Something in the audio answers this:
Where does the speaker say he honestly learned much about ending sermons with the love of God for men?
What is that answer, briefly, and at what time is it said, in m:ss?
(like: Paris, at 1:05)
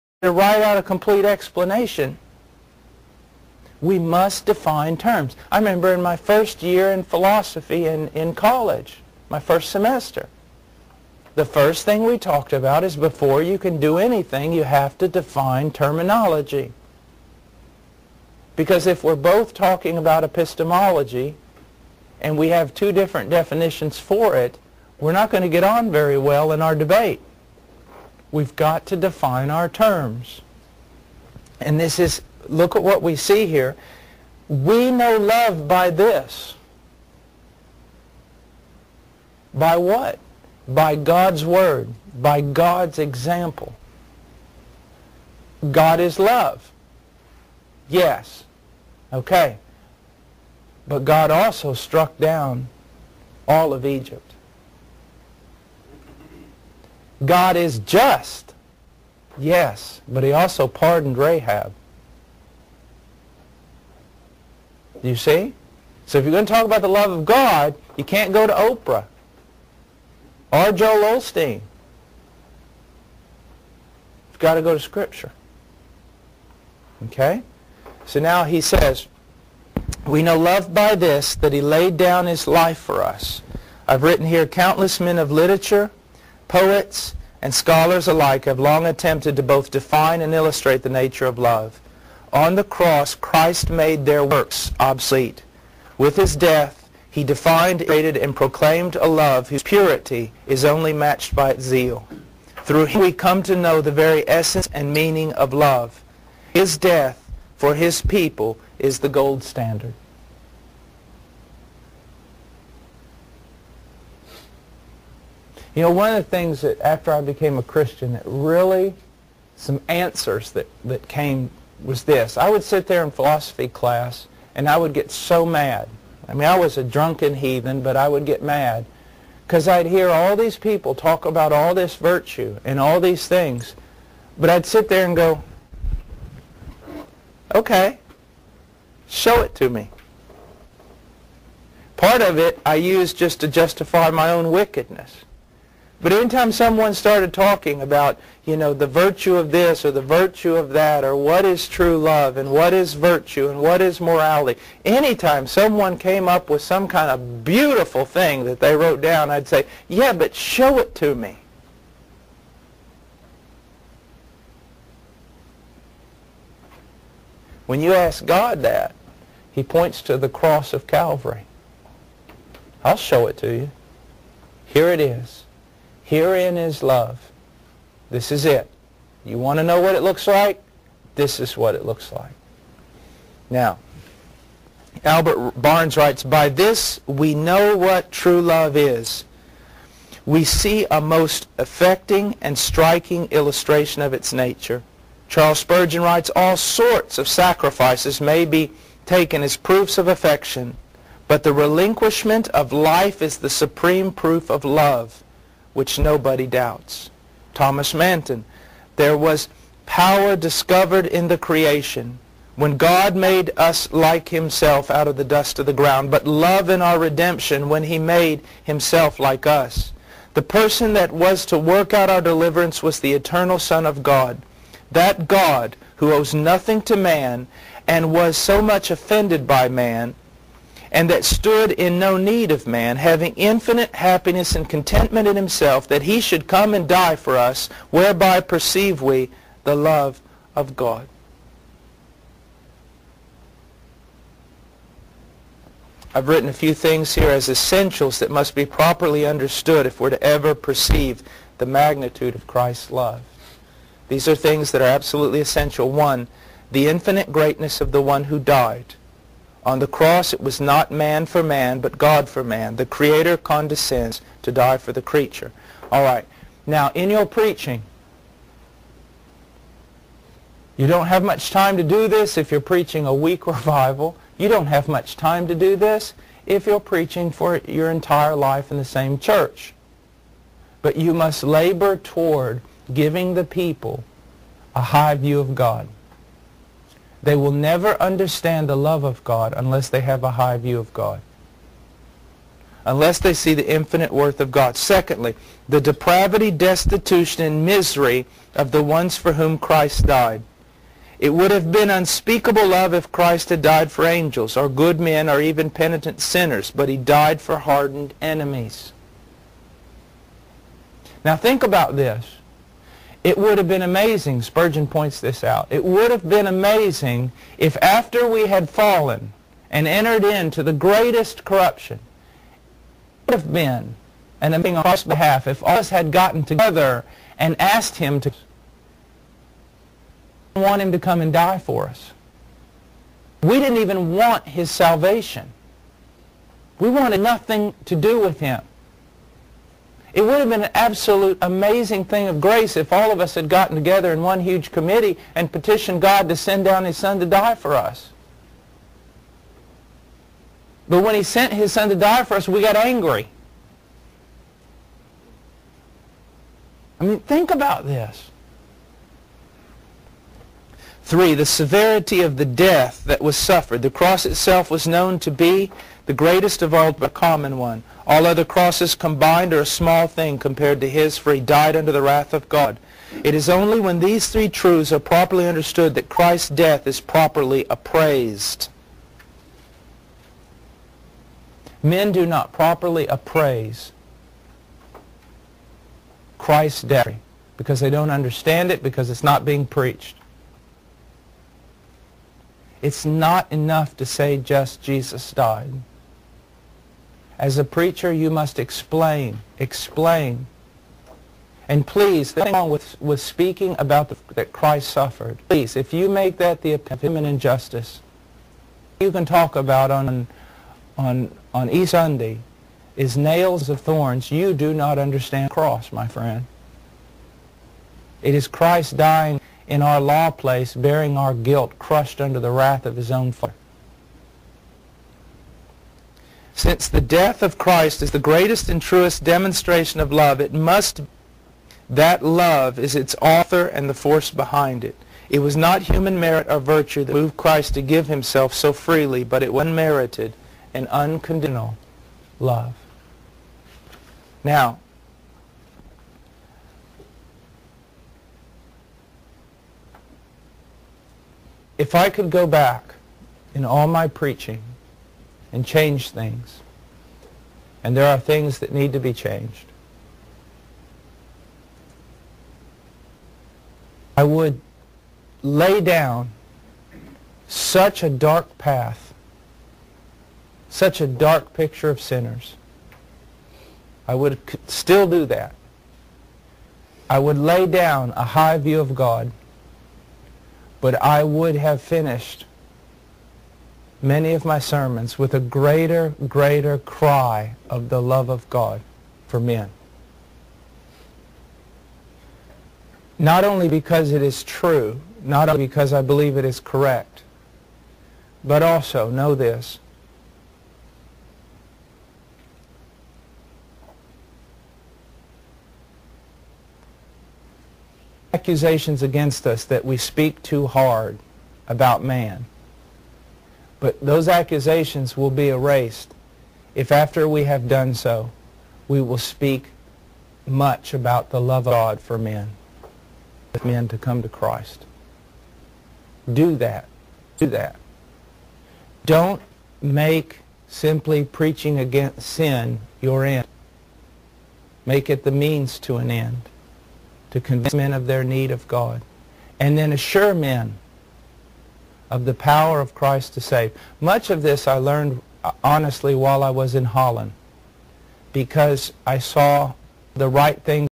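Holland, at 9:06.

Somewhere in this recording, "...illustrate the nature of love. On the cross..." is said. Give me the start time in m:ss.
1:30.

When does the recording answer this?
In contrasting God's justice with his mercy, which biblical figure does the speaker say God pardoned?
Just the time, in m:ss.
1:01.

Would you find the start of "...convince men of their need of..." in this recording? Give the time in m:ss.
8:57.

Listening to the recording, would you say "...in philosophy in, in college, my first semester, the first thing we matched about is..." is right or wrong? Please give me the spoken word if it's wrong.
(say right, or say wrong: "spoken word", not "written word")
wrong: "talked", not "matched".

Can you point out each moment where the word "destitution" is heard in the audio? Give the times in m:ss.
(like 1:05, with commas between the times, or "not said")
4:56.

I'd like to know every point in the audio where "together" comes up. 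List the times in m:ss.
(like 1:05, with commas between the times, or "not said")
5:26, 5:43.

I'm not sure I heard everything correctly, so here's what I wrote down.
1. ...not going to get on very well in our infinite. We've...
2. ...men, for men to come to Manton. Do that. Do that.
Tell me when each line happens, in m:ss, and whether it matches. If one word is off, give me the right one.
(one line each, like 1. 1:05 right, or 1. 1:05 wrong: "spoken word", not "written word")
1. 0:25 wrong: "debate", not "infinite"
2. 8:42 wrong: "Christ", not "Manton".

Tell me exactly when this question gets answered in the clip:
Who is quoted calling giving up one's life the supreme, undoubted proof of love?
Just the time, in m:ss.
3:15.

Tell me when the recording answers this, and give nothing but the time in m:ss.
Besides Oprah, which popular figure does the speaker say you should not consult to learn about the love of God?
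1:10.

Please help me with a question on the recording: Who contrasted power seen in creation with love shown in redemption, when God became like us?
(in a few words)
Thomas Manton.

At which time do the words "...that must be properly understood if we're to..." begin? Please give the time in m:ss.
4:08.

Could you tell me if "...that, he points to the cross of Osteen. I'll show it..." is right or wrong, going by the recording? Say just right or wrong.
wrong.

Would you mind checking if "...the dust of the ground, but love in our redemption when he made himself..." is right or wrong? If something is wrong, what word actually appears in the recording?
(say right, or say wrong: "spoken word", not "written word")
right.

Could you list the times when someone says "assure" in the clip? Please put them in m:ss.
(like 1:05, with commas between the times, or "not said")
8:59.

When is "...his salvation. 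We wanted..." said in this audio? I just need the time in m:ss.
5:34.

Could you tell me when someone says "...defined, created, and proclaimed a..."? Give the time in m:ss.
1:37.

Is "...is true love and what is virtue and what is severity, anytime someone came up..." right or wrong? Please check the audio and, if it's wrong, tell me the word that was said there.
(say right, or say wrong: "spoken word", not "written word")
wrong: "morality", not "severity".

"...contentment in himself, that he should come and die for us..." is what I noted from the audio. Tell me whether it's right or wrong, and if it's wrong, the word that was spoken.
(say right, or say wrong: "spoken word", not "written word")
right.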